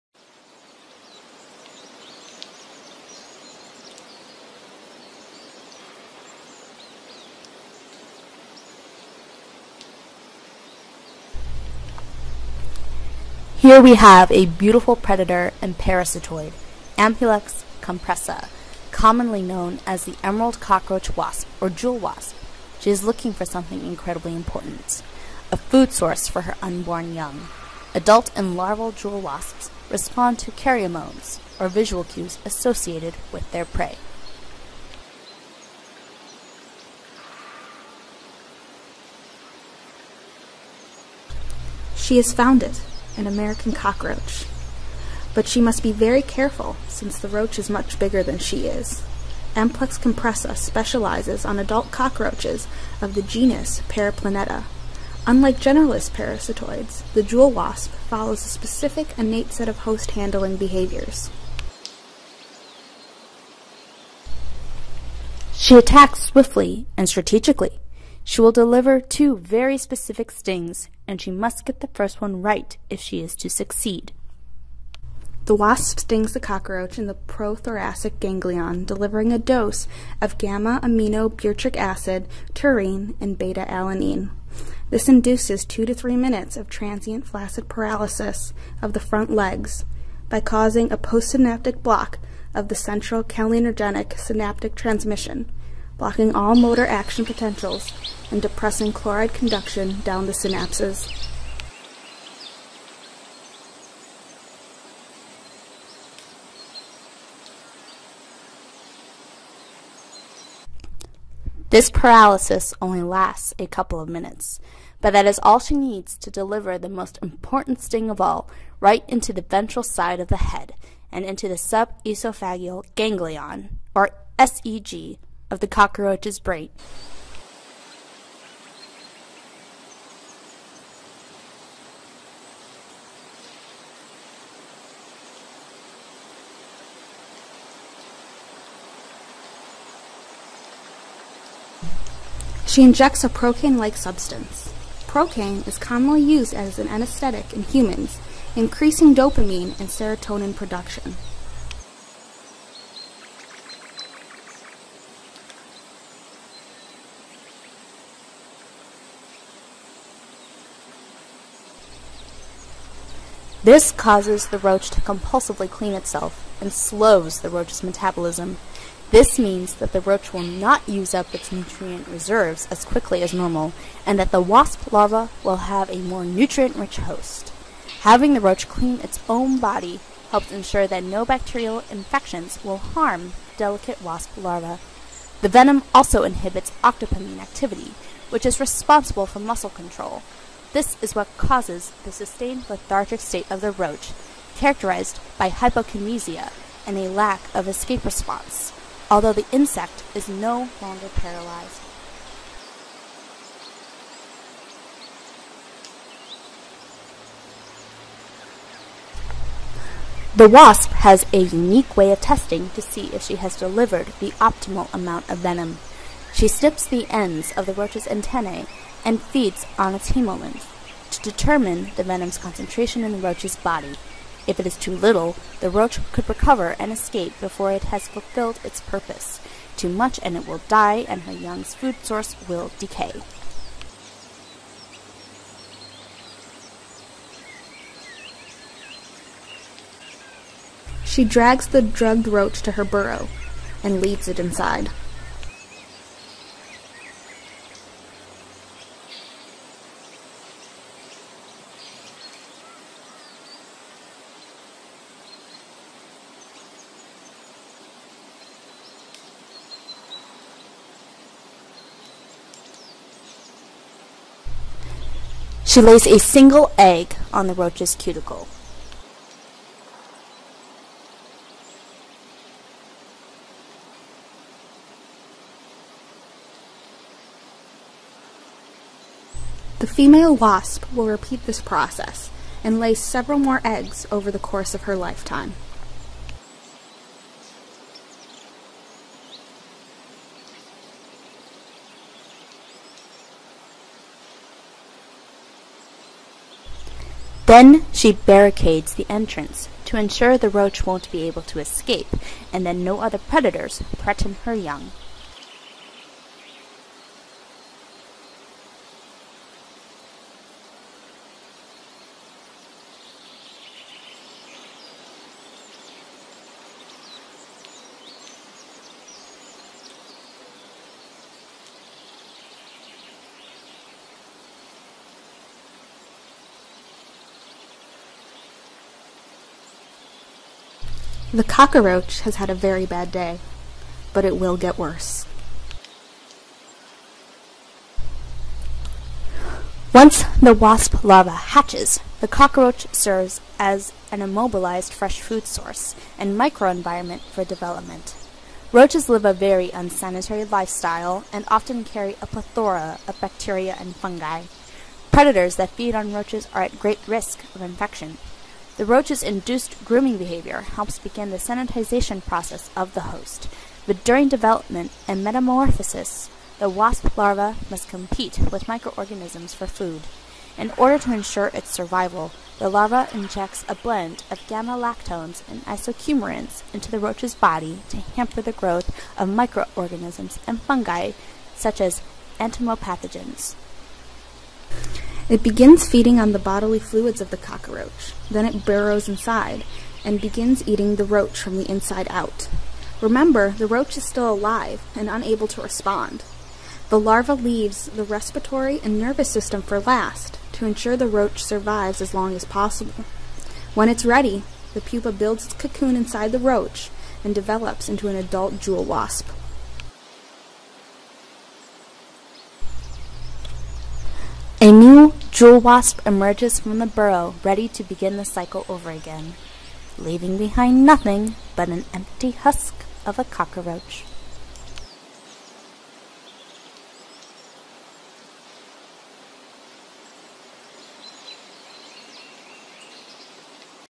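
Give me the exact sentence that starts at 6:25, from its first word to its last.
It begins feeding on the bodily fluids of the cockroach.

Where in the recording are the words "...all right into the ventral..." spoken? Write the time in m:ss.
1:58.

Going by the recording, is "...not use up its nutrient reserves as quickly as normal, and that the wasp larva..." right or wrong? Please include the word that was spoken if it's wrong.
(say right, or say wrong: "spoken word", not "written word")
right.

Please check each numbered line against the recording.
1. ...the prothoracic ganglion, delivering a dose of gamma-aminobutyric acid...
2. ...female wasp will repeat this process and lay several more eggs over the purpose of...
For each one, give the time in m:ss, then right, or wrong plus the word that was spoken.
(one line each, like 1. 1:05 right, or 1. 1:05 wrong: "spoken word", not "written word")
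1. 1:17 right
2. 4:39 wrong: "course", not "purpose".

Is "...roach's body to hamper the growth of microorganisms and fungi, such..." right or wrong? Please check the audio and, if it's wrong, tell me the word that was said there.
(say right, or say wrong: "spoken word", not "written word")
right.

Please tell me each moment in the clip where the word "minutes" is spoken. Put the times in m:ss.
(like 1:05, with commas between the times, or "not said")
1:26, 1:54.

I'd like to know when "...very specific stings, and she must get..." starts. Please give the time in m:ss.
1:09.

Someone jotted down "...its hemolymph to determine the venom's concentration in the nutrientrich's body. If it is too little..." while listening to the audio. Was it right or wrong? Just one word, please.
wrong.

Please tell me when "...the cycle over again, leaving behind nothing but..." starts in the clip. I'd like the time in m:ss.
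6:58.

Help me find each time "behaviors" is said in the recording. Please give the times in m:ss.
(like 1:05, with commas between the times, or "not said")
1:00, 6:00.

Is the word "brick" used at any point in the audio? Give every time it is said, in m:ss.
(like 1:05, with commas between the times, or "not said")
not said.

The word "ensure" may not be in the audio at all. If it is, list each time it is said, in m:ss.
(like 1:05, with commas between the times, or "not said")
3:00, 4:59, 6:11, 6:40.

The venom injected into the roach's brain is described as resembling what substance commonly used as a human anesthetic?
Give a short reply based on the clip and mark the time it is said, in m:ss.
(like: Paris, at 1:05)
procaine, at 2:23.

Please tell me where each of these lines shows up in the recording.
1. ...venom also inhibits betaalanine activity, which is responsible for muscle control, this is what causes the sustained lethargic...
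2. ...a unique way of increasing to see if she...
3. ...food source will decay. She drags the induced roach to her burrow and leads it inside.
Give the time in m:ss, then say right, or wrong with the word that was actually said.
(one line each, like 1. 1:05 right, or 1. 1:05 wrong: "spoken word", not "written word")
1. 3:05 wrong: "octopamine", not "betaalanine"
2. 3:31 wrong: "testing", not "increasing"
3. 3:51 wrong: "drugged", not "induced".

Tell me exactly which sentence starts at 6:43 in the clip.
When it's ready, the pupa builds its cocoon inside the roach and develops into an adult jewel wasp.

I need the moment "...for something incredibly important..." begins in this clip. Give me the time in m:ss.
0:23.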